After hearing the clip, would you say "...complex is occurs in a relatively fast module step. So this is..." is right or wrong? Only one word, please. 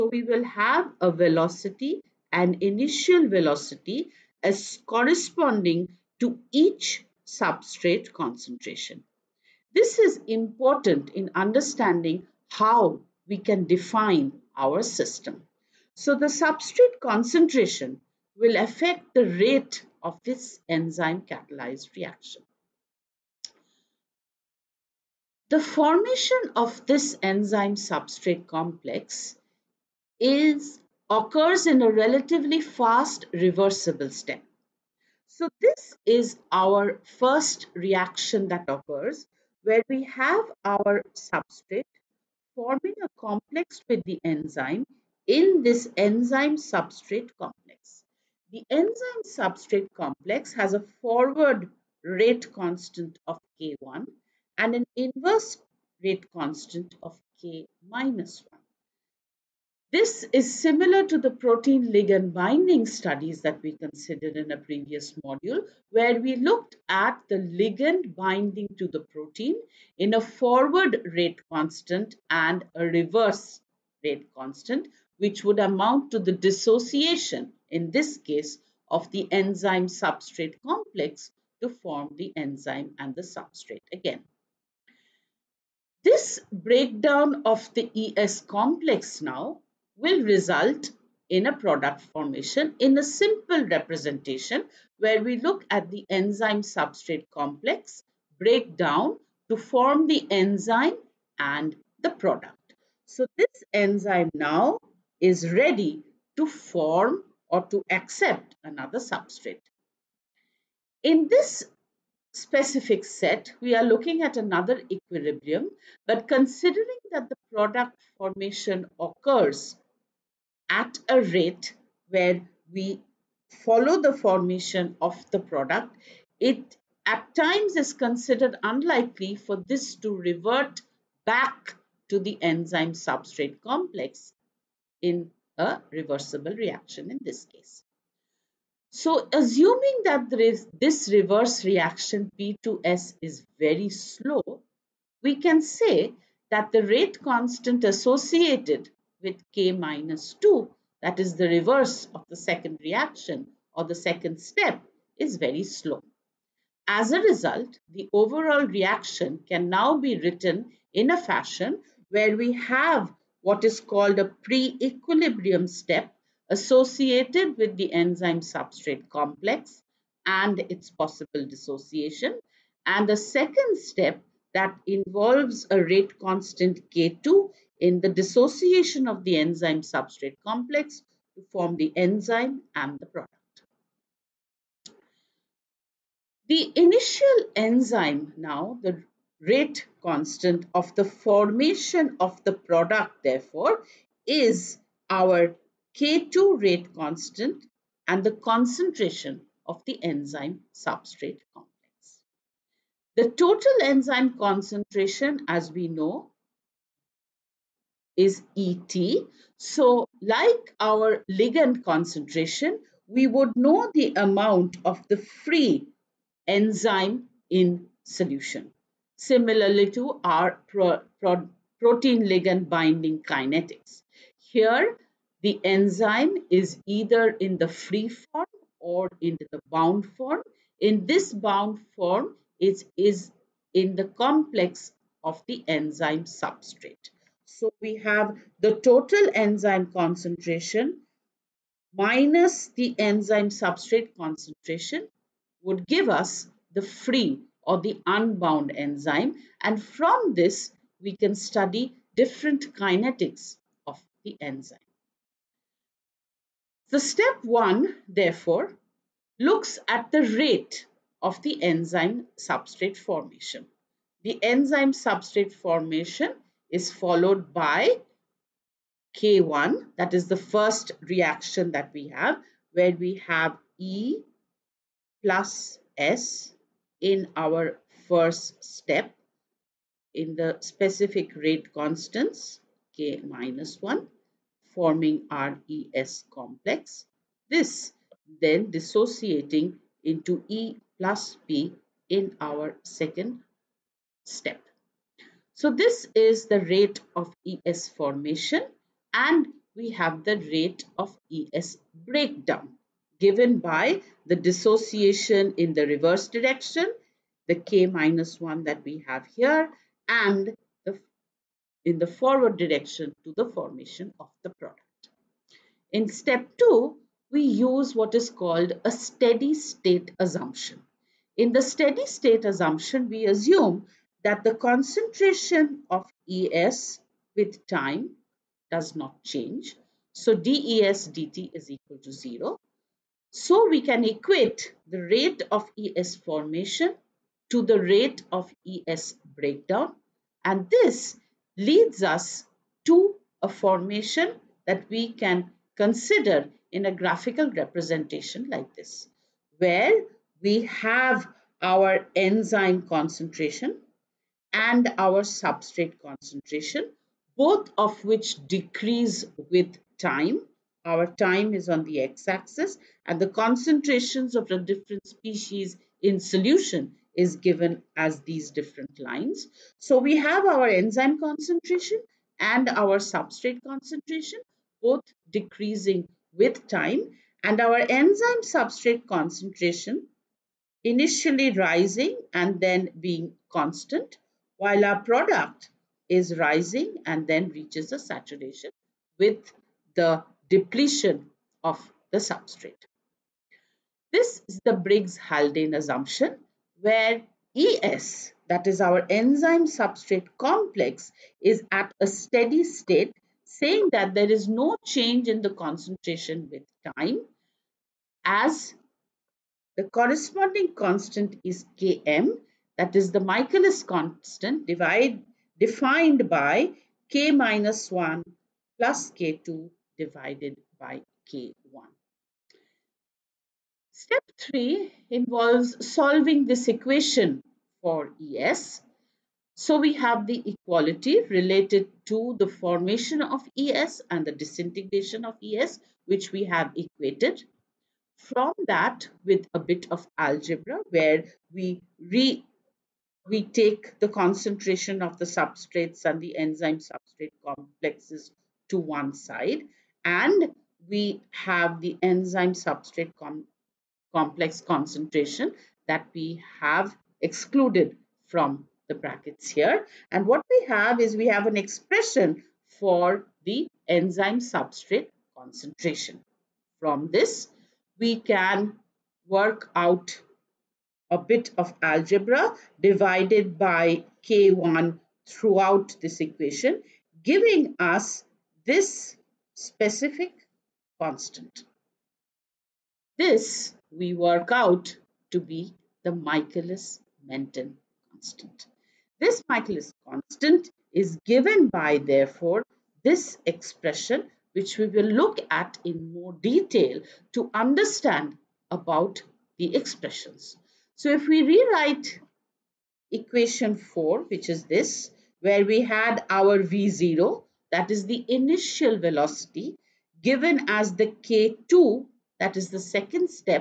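wrong.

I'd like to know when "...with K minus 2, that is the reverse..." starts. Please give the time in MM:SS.
02:29.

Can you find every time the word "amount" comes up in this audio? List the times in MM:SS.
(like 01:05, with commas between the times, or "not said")
01:15, 03:34.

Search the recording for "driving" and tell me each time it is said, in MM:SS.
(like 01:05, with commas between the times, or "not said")
not said.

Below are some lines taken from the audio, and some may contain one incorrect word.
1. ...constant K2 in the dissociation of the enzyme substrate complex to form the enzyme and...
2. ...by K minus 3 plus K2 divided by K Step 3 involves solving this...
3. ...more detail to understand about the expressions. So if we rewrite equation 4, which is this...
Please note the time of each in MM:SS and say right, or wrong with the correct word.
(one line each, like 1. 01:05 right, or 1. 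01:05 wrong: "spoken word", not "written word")
1. 02:56 right
2. 06:56 wrong: "1", not "3"
3. 08:16 right.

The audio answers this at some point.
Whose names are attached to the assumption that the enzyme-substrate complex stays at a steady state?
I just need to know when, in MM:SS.
06:34.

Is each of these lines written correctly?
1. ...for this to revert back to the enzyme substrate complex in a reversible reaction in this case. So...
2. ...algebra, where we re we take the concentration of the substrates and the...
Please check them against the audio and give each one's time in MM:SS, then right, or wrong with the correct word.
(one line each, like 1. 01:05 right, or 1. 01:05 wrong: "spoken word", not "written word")
1. 02:09 right
2. 07:20 right.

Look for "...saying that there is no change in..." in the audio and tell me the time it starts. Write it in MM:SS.
06:43.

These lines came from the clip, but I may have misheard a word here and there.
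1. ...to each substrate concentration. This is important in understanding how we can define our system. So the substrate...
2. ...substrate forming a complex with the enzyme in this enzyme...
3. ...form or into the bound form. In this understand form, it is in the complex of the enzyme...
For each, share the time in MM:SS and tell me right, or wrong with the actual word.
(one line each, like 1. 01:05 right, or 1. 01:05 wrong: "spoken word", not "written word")
1. 00:06 right
2. 00:41 right
3. 03:48 wrong: "bound", not "understand".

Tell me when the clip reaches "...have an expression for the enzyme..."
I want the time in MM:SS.
07:41.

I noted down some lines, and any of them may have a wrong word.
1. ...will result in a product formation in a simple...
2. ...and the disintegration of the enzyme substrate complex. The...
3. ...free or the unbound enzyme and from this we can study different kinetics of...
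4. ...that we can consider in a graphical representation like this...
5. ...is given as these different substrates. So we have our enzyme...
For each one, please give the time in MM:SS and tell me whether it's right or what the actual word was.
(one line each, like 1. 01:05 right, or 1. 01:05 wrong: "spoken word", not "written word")
1. 01:29 right
2. 03:18 wrong: "concentration", not "disintegration"
3. 04:06 right
4. 05:44 right
5. 06:07 wrong: "lines", not "substrates".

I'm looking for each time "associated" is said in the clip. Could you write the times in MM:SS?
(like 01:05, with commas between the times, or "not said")
02:27, 02:46.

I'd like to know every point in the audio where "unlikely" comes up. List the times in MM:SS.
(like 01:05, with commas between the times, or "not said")
02:08.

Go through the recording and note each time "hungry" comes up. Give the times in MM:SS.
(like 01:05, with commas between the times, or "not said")
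not said.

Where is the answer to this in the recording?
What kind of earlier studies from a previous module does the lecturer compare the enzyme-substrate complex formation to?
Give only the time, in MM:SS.
01:01.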